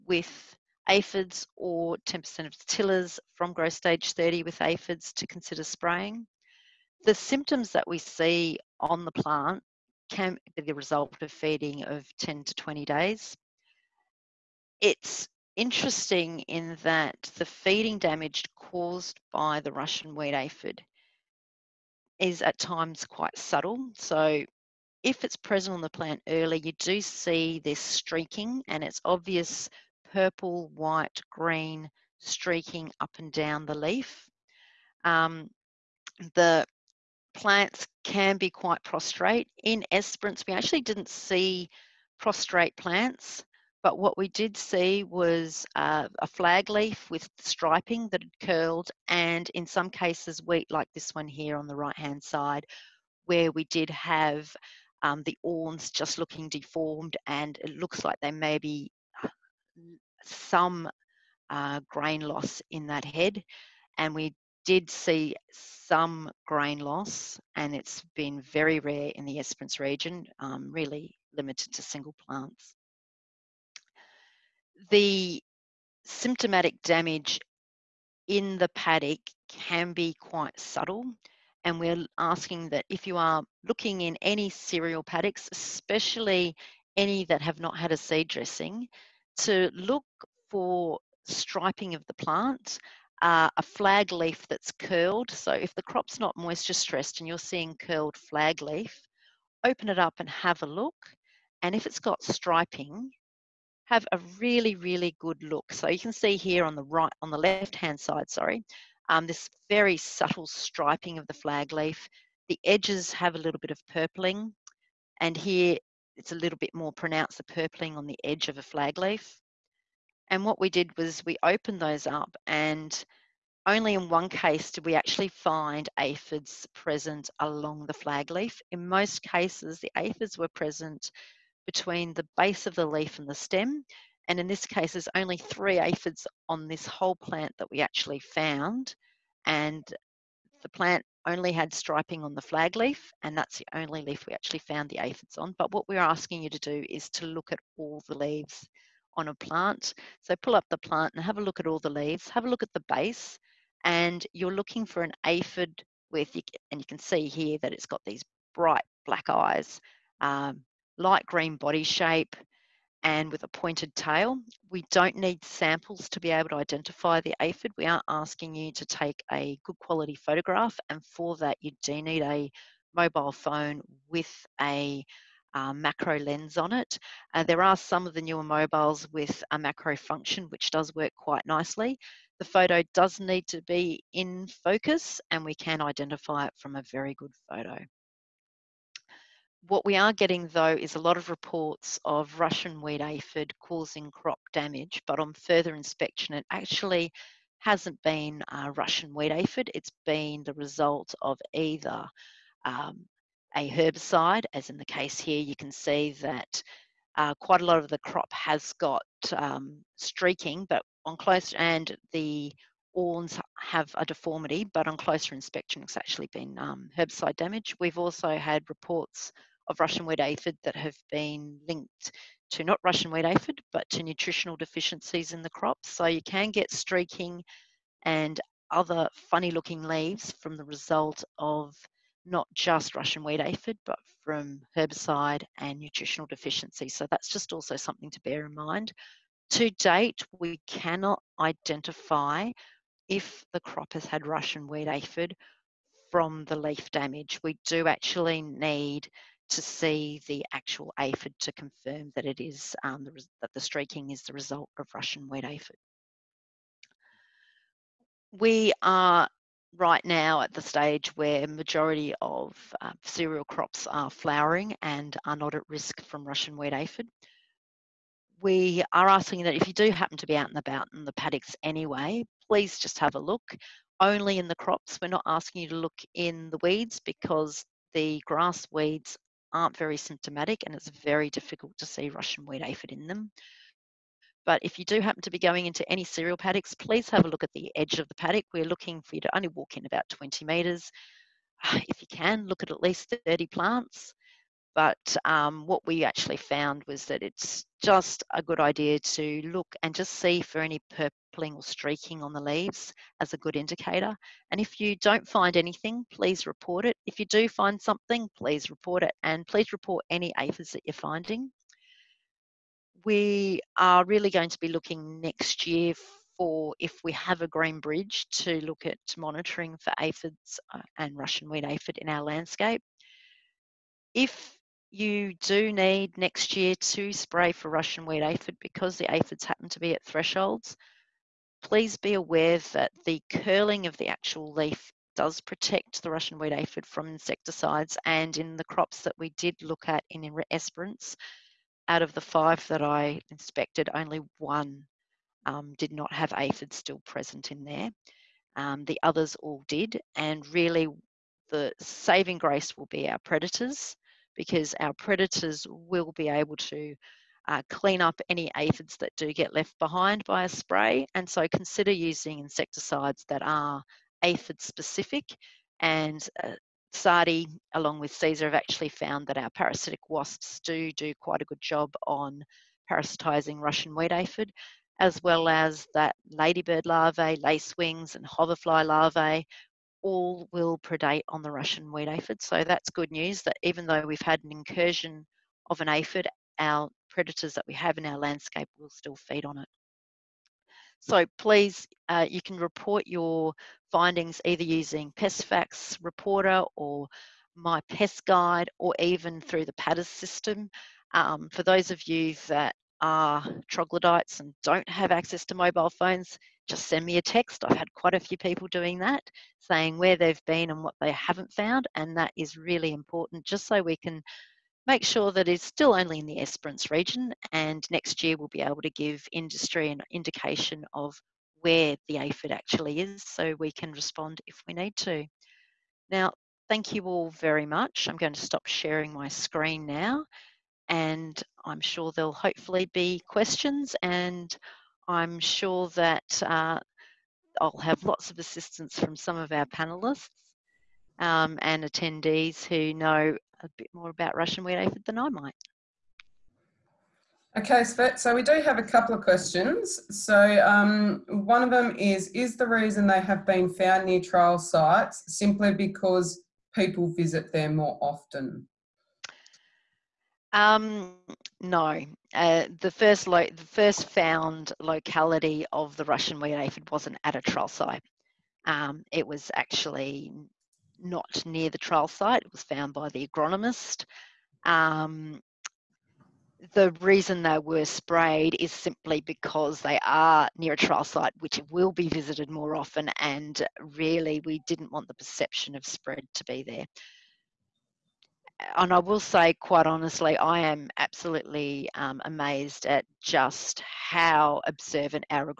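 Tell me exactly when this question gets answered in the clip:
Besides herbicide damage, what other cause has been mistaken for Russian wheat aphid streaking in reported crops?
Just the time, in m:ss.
3:44.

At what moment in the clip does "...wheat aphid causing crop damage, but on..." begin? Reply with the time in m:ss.
3:12.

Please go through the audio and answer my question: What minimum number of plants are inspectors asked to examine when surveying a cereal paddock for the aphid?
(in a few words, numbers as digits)
30.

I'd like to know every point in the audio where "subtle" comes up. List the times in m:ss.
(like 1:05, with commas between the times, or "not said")
0:23, 1:20, 1:49.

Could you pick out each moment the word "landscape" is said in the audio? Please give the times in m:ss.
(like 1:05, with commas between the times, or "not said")
5:22, 6:28.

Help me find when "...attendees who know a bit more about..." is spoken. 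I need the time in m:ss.
7:21.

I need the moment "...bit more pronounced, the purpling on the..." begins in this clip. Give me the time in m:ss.
1:56.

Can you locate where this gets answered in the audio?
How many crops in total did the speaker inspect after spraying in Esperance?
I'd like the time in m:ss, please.
5:42.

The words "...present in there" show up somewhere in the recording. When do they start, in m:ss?
5:46.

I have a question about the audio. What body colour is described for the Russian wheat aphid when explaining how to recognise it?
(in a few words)
Light green.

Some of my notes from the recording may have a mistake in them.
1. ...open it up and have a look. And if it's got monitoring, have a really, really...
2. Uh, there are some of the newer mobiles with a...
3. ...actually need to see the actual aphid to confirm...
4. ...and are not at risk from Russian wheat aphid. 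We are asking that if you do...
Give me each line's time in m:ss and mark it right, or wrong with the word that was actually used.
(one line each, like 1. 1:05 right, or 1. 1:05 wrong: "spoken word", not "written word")
1. 1:39 wrong: "striping", not "monitoring"
2. 2:57 right
3. 4:07 right
4. 4:24 right.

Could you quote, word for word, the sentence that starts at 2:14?
And in this case, there's only three aphids on this whole plant that we actually found.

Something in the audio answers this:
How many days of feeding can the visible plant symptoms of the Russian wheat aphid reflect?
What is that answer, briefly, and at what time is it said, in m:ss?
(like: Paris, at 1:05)
10 to 20 days, at 0:12.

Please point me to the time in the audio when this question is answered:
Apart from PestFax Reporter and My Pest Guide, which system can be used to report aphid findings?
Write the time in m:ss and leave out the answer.
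6:39.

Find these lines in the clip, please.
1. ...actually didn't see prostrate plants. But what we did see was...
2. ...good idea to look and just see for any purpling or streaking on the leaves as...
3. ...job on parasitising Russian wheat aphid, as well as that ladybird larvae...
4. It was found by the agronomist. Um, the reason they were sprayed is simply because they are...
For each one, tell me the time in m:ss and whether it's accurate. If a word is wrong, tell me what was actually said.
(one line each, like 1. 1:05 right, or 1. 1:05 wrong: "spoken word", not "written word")
1. 0:40 right
2. 4:58 right
3. 6:11 right
4. 7:52 right.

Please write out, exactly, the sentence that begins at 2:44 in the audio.
We don't need samples to be able to identify the aphid.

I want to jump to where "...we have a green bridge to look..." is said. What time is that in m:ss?
5:17.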